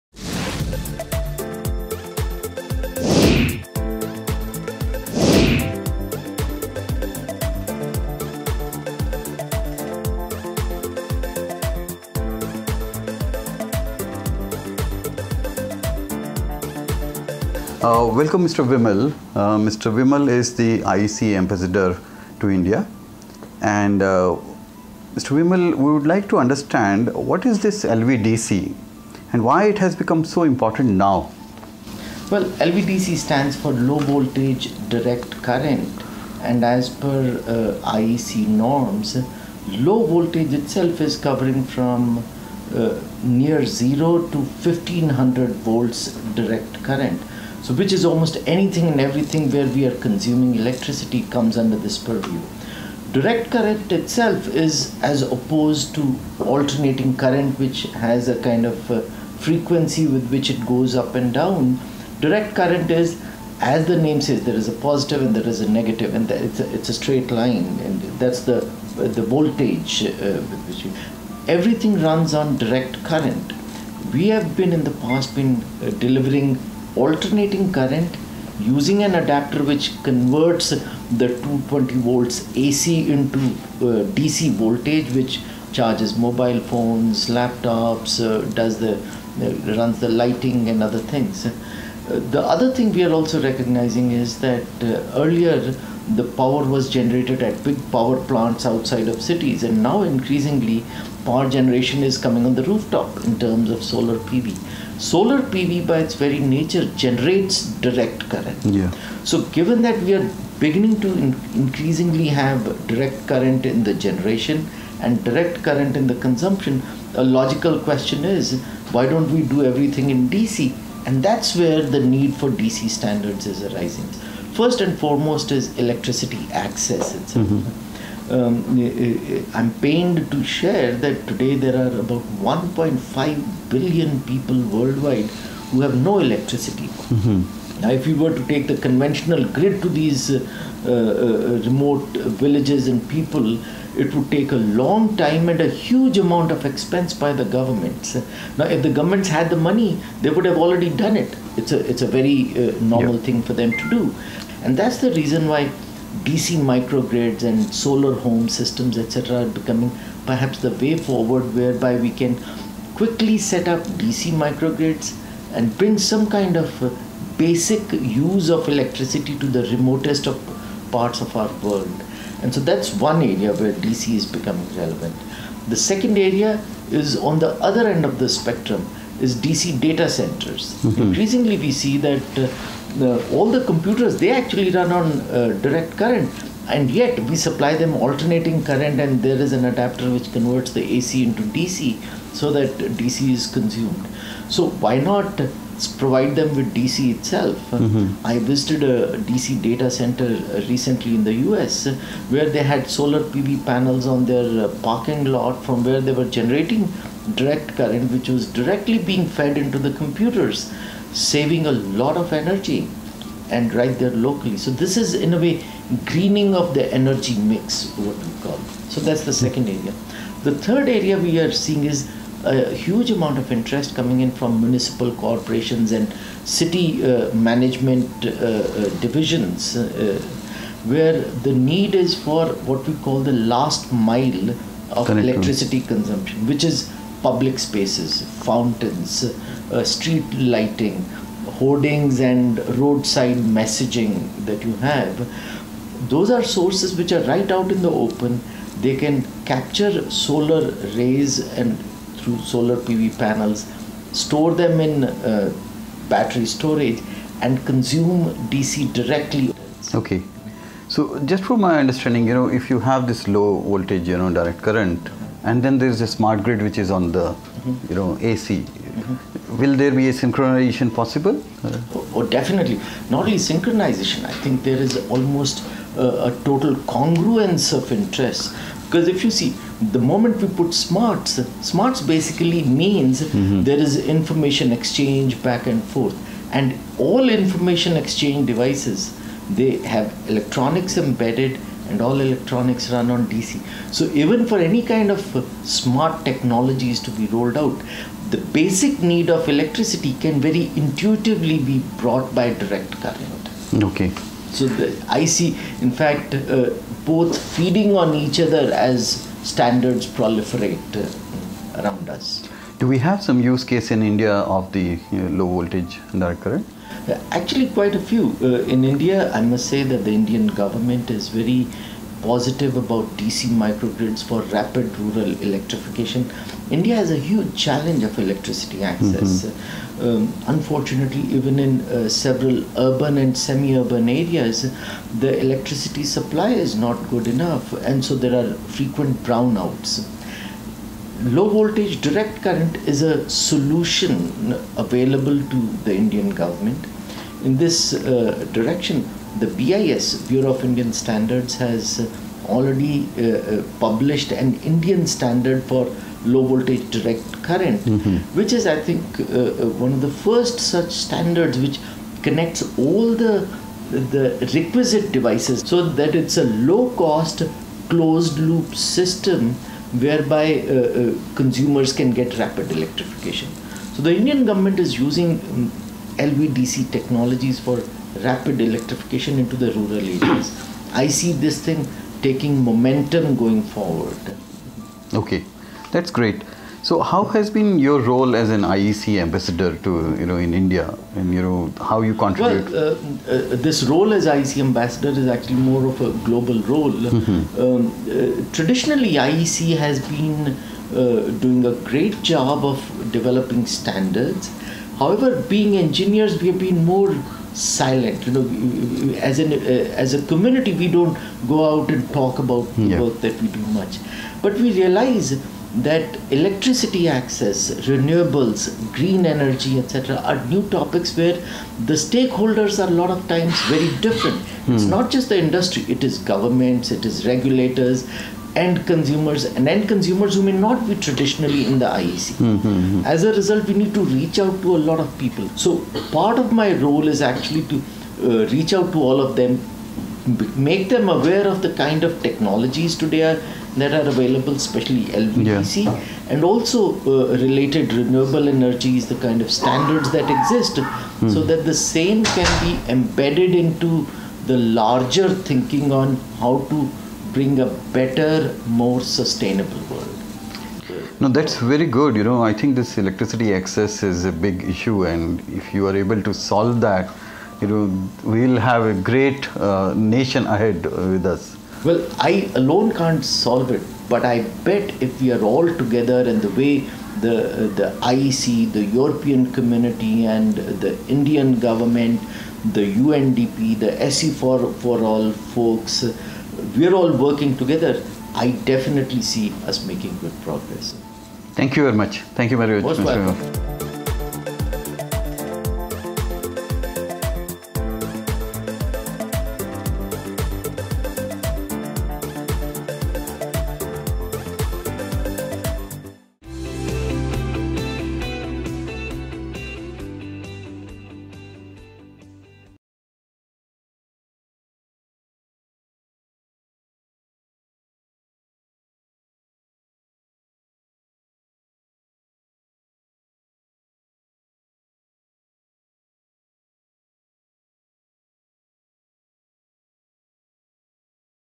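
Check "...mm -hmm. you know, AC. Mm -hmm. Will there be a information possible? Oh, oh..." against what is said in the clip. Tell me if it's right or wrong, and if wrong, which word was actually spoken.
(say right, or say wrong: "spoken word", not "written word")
wrong: "synchronization", not "information".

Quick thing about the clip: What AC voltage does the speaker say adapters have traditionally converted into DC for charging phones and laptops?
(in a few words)
220 volts.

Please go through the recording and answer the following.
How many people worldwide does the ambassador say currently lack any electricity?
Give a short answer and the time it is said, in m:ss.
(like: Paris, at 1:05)
1.5 billion, at 2:12.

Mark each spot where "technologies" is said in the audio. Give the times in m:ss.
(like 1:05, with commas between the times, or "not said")
4:56, 6:16, 7:22.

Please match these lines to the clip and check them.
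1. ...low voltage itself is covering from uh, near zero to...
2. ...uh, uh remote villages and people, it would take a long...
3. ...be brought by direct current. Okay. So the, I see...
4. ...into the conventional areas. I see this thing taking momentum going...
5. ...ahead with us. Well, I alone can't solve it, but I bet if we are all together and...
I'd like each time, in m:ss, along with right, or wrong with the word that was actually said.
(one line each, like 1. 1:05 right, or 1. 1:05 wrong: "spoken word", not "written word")
1. 0:39 right
2. 2:20 right
3. 5:01 right
4. 6:19 wrong: "rural", not "conventional"
5. 7:50 right.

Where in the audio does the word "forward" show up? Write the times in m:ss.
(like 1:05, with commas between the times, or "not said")
2:40, 6:23.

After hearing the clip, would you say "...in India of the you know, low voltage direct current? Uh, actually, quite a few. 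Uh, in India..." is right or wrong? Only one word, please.
right.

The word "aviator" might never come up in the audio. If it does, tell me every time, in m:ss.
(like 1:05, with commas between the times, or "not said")
not said.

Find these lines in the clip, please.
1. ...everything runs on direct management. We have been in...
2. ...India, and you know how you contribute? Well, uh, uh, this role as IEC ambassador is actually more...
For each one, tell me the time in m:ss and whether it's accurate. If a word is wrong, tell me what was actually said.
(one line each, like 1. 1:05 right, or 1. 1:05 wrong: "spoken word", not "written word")
1. 1:11 wrong: "current", not "management"
2. 6:30 right.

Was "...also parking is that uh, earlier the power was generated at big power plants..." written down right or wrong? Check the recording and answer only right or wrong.
wrong.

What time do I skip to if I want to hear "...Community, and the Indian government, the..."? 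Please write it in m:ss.
7:59.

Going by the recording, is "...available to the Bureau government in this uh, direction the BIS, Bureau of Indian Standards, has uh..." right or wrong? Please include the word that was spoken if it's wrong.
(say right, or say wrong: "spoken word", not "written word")
wrong: "Indian", not "Bureau".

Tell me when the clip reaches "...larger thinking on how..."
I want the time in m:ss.
7:34.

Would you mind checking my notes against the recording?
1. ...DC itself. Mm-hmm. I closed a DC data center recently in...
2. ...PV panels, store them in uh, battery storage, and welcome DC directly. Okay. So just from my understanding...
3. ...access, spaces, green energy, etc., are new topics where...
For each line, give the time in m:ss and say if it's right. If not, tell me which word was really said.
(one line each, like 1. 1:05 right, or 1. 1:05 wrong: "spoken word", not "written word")
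1. 3:16 wrong: "visited", not "closed"
2. 4:12 wrong: "consume", not "welcome"
3. 6:57 wrong: "renewables", not "spaces".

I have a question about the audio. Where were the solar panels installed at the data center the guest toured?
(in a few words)
parking lot.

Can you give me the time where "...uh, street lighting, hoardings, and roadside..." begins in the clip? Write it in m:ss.
3:59.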